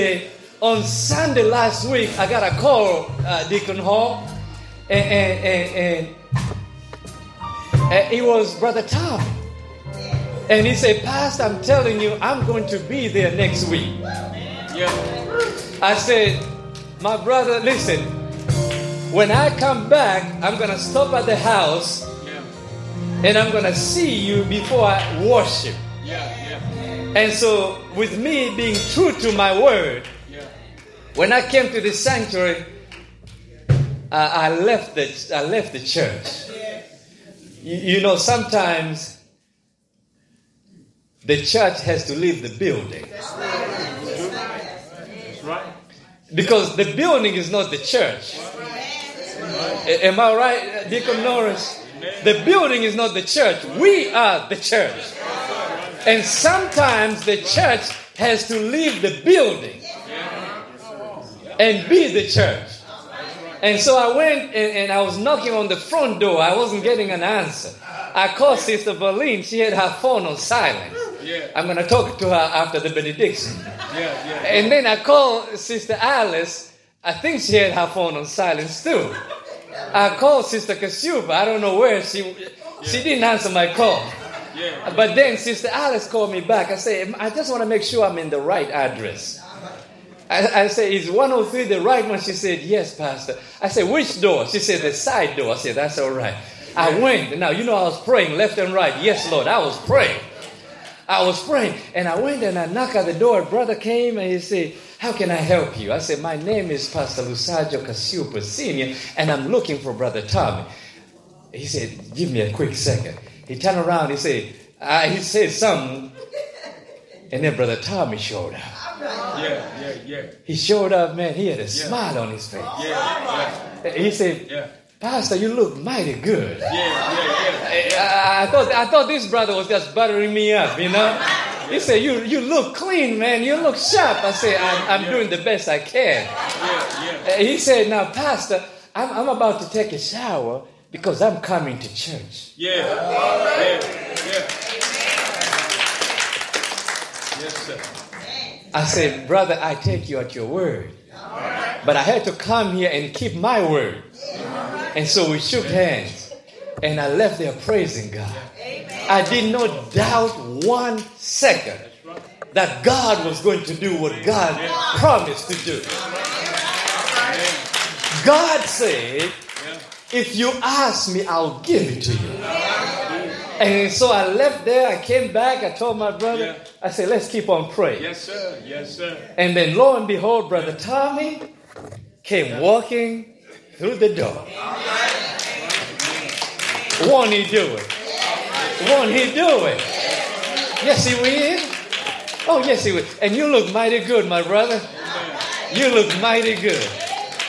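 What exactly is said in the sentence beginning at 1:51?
He said, give me a quick second.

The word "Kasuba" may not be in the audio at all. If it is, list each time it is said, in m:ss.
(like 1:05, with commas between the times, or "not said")
1:20.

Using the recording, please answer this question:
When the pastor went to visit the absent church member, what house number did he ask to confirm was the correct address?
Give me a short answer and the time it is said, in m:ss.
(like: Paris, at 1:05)
103, at 1:31.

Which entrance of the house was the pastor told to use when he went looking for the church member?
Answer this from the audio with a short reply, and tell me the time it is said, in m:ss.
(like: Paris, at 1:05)
The side door, at 1:34.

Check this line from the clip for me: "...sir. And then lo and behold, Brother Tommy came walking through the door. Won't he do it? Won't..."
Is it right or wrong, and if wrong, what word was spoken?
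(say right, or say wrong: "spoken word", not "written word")
right.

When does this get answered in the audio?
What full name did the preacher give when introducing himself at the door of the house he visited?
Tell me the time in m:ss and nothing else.
1:46.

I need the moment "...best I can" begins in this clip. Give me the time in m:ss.
2:15.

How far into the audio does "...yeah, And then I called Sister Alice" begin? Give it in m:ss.
1:14.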